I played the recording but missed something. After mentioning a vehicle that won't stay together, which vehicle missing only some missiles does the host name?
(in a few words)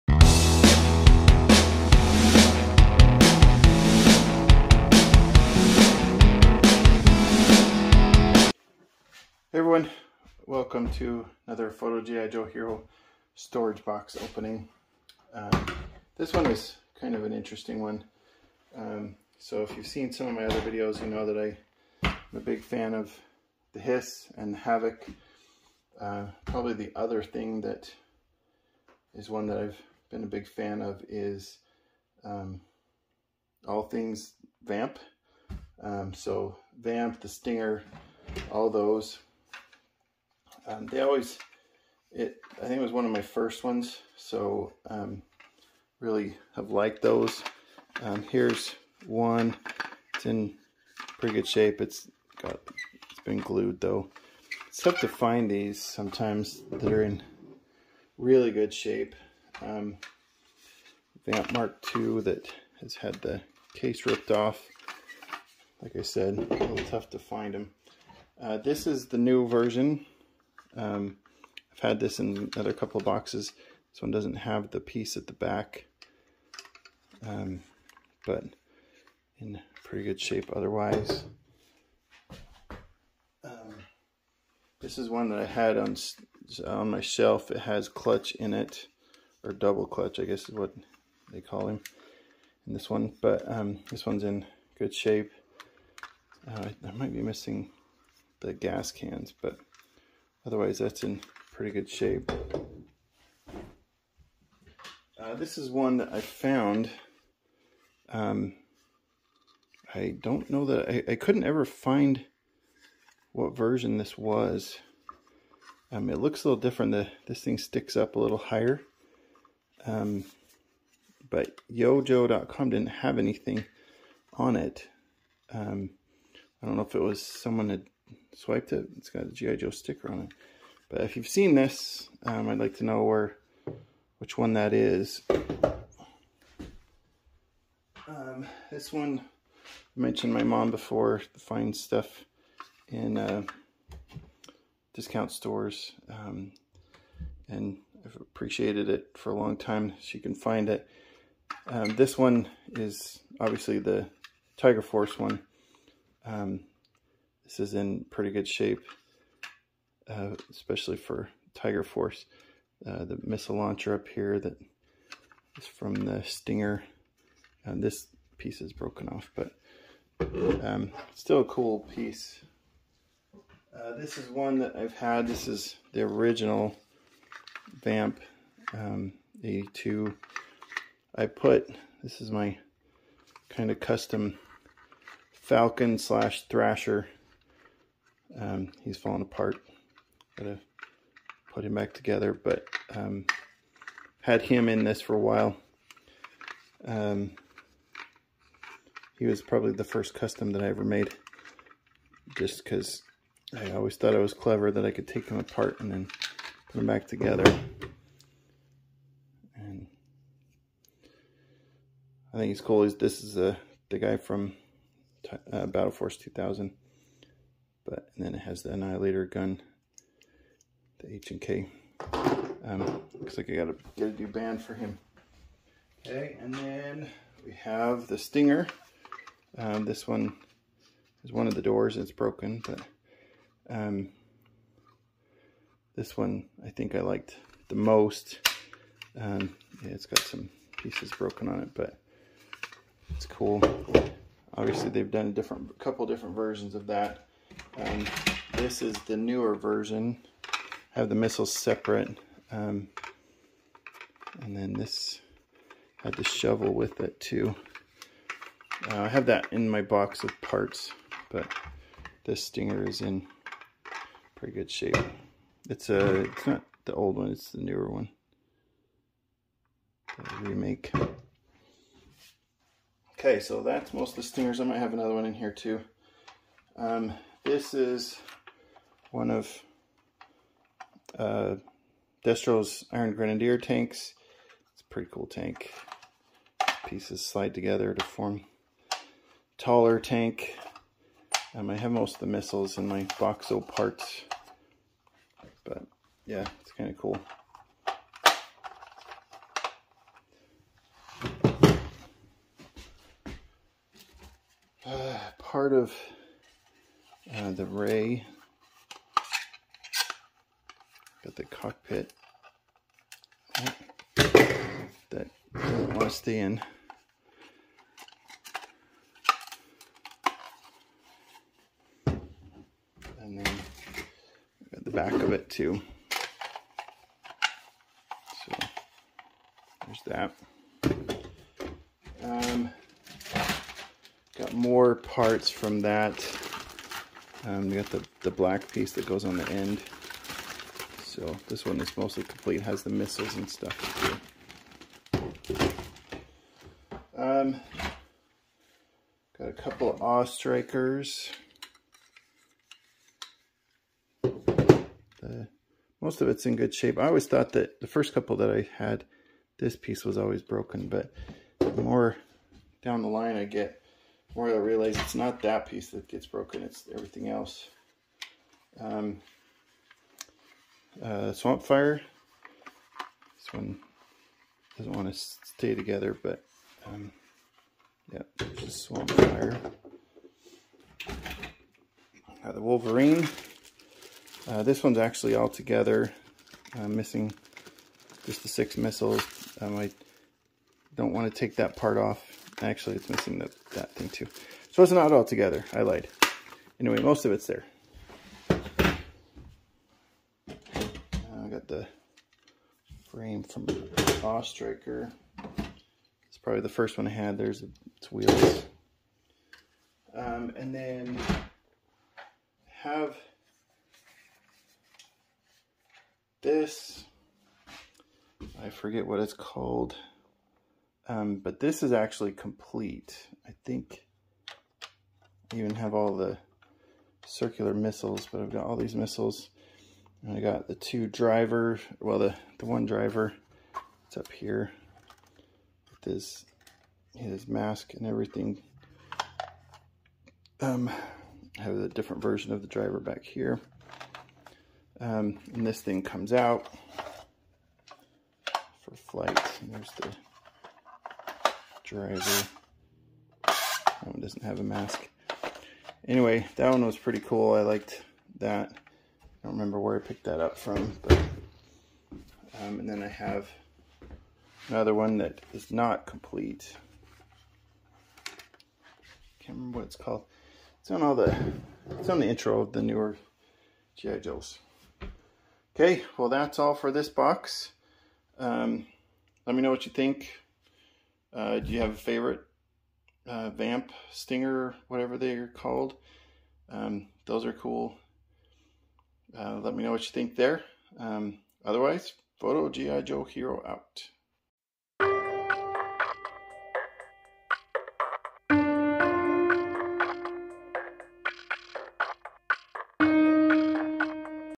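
Wolverine.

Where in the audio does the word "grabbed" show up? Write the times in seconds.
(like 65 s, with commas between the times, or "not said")
not said.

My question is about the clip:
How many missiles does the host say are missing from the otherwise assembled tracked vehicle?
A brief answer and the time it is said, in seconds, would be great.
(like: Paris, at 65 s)
6, at 388 s.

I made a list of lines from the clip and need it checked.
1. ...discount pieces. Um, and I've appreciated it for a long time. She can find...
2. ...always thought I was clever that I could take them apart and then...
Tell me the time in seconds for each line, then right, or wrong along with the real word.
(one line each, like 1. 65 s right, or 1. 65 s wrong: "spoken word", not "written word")
1. 144 s wrong: "stores", not "pieces"
2. 203 s right.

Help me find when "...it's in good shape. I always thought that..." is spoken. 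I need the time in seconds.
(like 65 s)
356 s.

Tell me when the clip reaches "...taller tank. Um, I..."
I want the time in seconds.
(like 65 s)
289 s.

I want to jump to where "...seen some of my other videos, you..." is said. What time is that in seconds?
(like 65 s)
19 s.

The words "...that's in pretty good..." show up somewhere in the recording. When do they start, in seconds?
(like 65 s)
100 s.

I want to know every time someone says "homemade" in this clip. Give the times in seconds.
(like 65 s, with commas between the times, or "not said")
not said.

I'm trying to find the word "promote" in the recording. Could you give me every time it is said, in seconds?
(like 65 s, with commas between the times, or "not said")
not said.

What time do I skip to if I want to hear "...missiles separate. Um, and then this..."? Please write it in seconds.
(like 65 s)
251 s.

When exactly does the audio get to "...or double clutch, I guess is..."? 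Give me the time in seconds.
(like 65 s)
89 s.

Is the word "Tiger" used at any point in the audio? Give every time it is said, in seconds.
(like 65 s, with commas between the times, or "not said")
154 s, 161 s.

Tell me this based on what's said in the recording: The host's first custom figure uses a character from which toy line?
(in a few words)
Battle Force 2000.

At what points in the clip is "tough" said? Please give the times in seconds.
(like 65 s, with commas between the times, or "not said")
54 s, 66 s.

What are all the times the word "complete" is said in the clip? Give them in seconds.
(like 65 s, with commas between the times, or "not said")
342 s, 422 s, 466 s.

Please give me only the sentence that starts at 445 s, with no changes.
Um, and this thing comes out for flight.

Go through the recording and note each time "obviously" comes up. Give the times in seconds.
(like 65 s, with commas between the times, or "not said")
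153 s, 244 s.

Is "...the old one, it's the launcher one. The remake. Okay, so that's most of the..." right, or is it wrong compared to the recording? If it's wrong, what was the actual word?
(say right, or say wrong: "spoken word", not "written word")
wrong: "newer", not "launcher".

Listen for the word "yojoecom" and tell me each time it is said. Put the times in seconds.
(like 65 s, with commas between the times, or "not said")
121 s.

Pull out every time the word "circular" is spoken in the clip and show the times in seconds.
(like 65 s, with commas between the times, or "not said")
427 s.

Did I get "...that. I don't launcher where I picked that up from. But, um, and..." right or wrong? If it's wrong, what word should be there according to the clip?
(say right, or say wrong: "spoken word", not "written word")
wrong: "remember", not "launcher".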